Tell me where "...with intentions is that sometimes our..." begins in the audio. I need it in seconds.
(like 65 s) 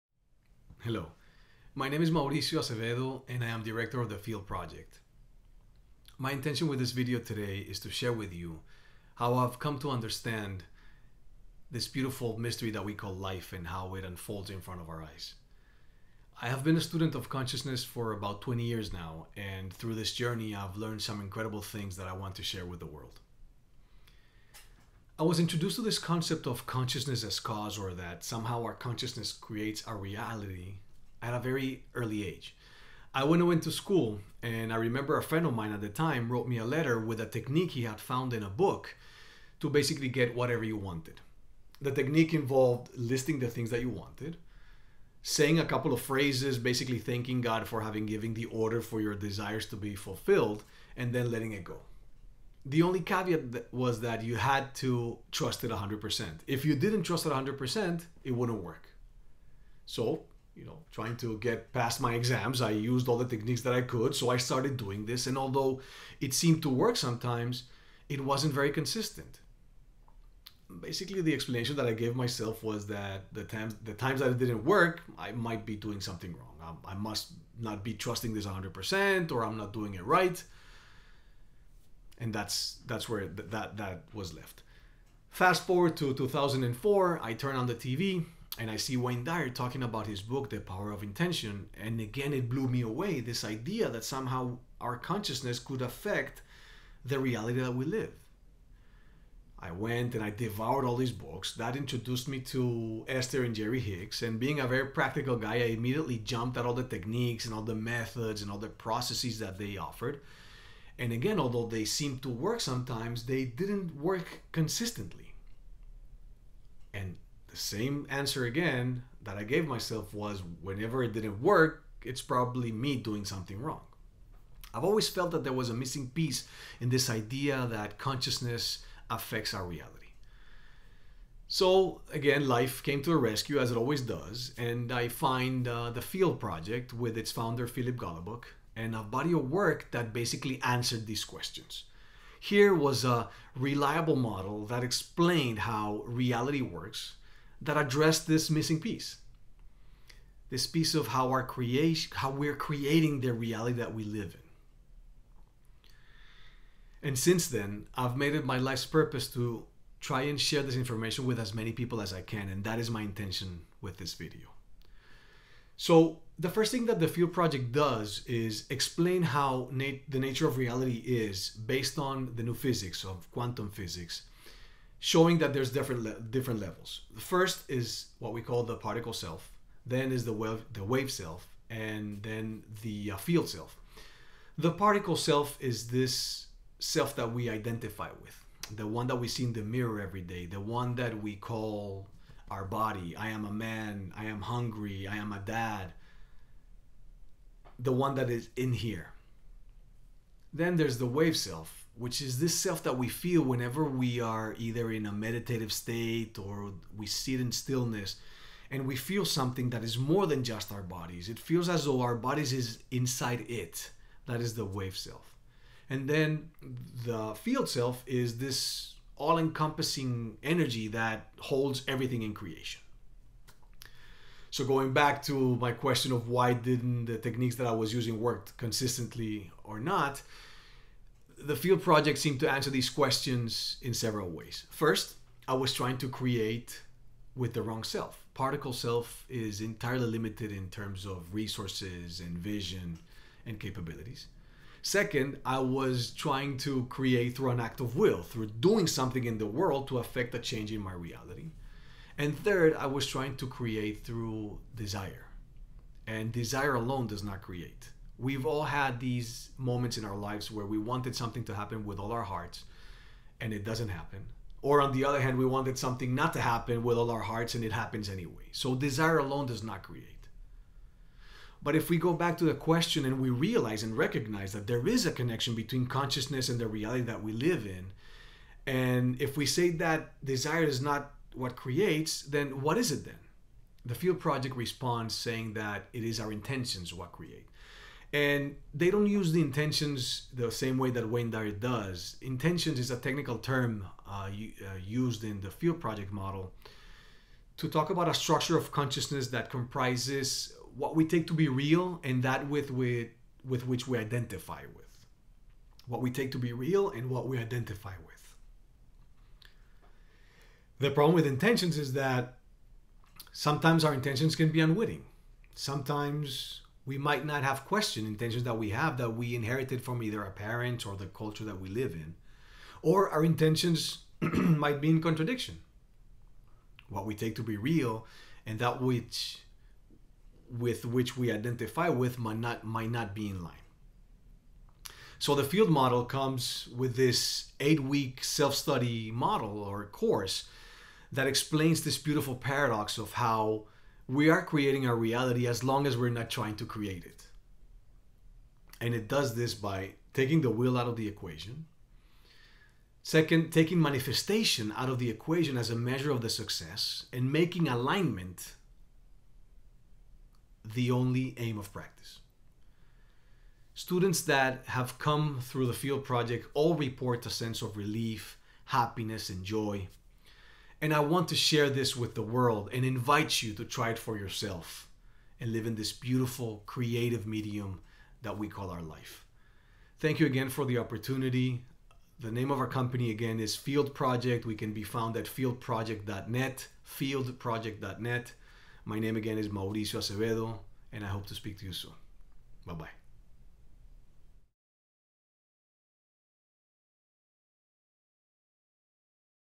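311 s.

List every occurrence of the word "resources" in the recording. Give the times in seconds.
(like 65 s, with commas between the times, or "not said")
241 s.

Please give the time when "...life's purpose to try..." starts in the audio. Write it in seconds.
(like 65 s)
158 s.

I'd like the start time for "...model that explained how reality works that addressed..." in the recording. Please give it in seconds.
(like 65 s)
144 s.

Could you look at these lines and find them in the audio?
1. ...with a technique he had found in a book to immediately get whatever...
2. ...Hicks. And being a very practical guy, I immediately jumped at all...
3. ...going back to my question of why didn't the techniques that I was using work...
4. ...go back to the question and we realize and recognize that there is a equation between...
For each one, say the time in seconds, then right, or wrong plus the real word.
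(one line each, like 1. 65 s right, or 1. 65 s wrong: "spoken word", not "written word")
1. 36 s wrong: "basically", not "immediately"
2. 103 s right
3. 224 s right
4. 271 s wrong: "connection", not "equation".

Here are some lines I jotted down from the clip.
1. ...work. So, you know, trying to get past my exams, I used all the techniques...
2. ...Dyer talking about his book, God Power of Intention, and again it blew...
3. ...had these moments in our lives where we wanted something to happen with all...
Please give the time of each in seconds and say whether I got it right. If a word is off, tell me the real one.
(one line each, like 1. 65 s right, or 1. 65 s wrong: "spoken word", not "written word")
1. 58 s right
2. 89 s wrong: "The", not "God"
3. 258 s right.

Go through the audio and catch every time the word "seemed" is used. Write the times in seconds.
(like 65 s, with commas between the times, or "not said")
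66 s, 111 s, 232 s.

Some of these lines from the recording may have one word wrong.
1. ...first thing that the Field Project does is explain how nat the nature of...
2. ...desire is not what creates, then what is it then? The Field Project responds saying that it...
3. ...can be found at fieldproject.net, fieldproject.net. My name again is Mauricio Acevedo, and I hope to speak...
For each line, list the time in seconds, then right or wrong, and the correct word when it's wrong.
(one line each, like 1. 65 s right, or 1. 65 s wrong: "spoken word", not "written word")
1. 166 s right
2. 280 s right
3. 384 s right.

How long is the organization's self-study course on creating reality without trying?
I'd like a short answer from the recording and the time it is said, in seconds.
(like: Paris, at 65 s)
8 weeks, at 337 s.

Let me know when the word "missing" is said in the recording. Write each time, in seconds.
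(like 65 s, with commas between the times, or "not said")
125 s, 148 s.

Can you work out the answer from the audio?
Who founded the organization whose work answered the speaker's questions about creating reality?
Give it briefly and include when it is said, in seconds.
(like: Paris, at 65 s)
Philip Golabuk, at 137 s.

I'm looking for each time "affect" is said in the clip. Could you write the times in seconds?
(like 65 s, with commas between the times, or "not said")
95 s, 129 s, 249 s.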